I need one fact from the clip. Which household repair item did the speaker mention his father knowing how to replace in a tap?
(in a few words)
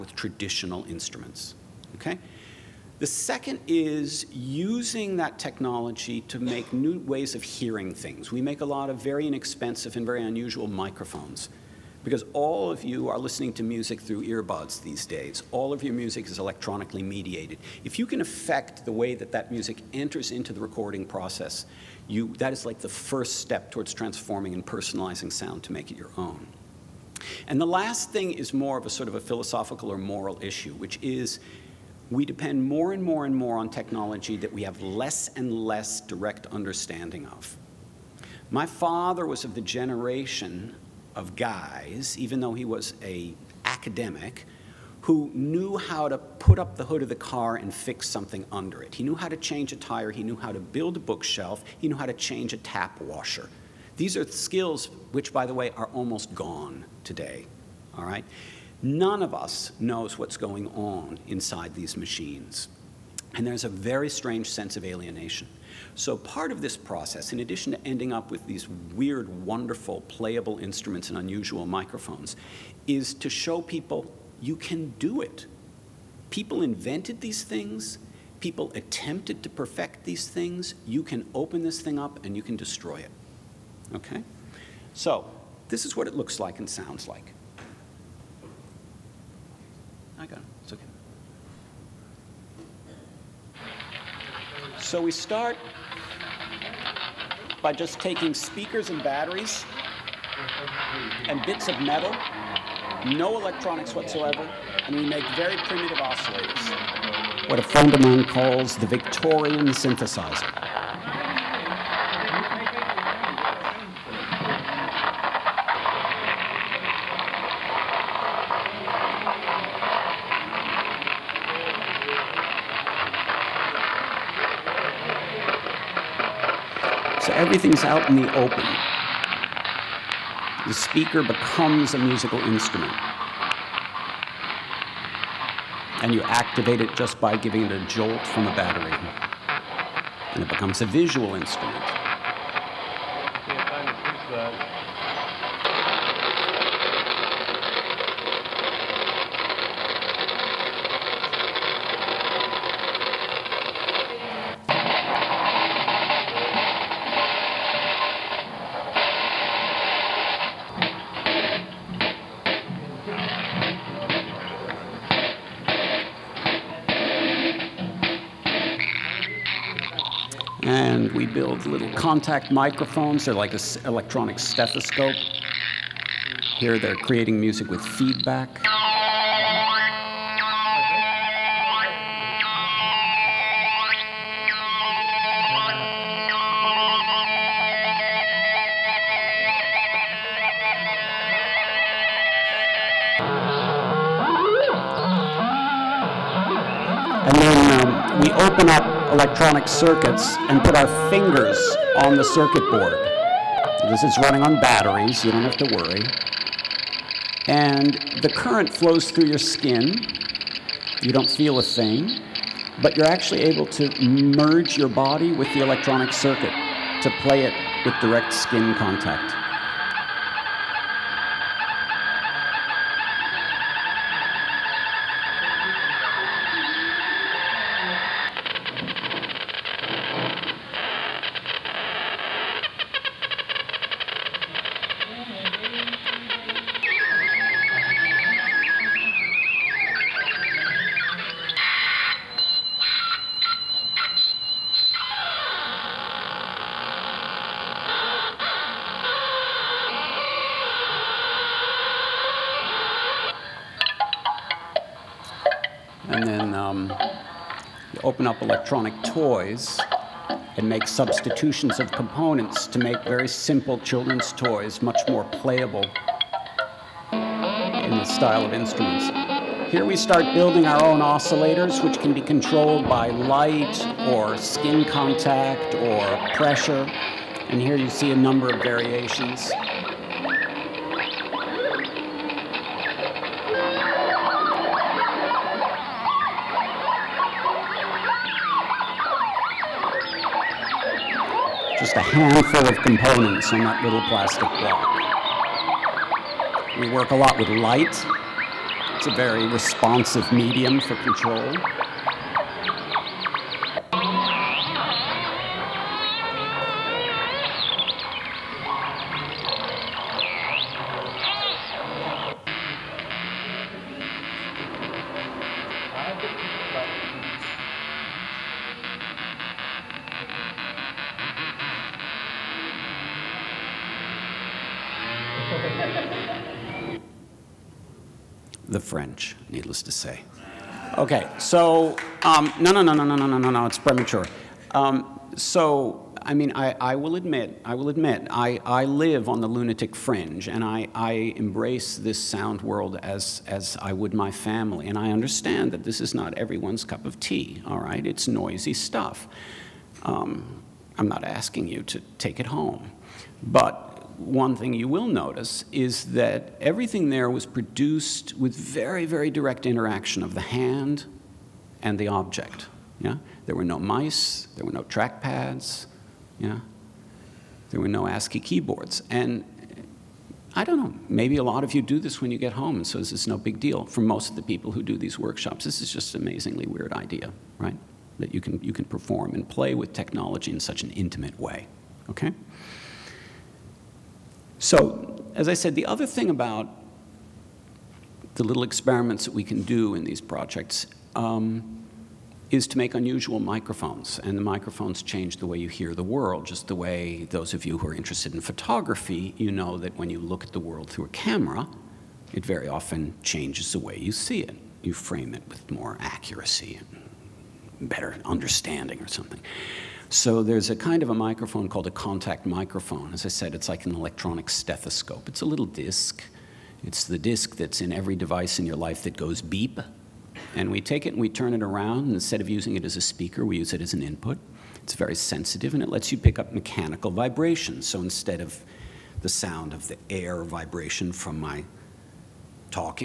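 Tap washer.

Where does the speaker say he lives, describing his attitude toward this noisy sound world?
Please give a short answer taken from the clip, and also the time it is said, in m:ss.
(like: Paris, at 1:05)
The lunatic fringe, at 5:39.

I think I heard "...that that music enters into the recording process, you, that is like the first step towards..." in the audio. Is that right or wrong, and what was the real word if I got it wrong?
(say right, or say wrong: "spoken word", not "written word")
right.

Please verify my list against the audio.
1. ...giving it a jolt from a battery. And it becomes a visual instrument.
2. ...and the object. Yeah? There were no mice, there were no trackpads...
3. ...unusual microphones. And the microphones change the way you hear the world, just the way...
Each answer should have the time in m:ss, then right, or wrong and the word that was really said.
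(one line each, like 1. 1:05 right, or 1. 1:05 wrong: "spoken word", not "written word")
1. 2:17 right
2. 6:01 right
3. 6:32 right.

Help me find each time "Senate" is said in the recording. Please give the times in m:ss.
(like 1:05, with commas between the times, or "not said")
not said.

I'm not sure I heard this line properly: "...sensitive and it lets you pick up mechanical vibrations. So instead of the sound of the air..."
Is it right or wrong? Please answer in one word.
right.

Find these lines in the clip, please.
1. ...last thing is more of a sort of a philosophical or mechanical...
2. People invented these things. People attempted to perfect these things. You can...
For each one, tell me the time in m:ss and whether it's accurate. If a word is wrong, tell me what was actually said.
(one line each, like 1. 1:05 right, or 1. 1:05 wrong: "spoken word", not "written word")
1. 0:27 wrong: "moral", not "mechanical"
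2. 1:16 right.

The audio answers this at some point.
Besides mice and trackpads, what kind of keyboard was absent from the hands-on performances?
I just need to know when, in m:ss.
6:08.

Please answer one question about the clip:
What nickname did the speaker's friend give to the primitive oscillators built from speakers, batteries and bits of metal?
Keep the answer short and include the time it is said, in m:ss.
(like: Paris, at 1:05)
Victorian synthesizer, at 1:48.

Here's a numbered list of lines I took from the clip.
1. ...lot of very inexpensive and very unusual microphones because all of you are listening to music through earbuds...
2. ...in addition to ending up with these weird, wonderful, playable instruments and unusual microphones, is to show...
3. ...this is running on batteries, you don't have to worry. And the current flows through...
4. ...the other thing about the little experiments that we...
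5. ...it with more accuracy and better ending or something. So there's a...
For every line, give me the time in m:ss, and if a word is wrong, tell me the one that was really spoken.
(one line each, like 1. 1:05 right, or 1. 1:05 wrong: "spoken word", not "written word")
1. 0:08 right
2. 1:07 right
3. 3:23 right
4. 6:25 right
5. 6:45 wrong: "understanding", not "ending".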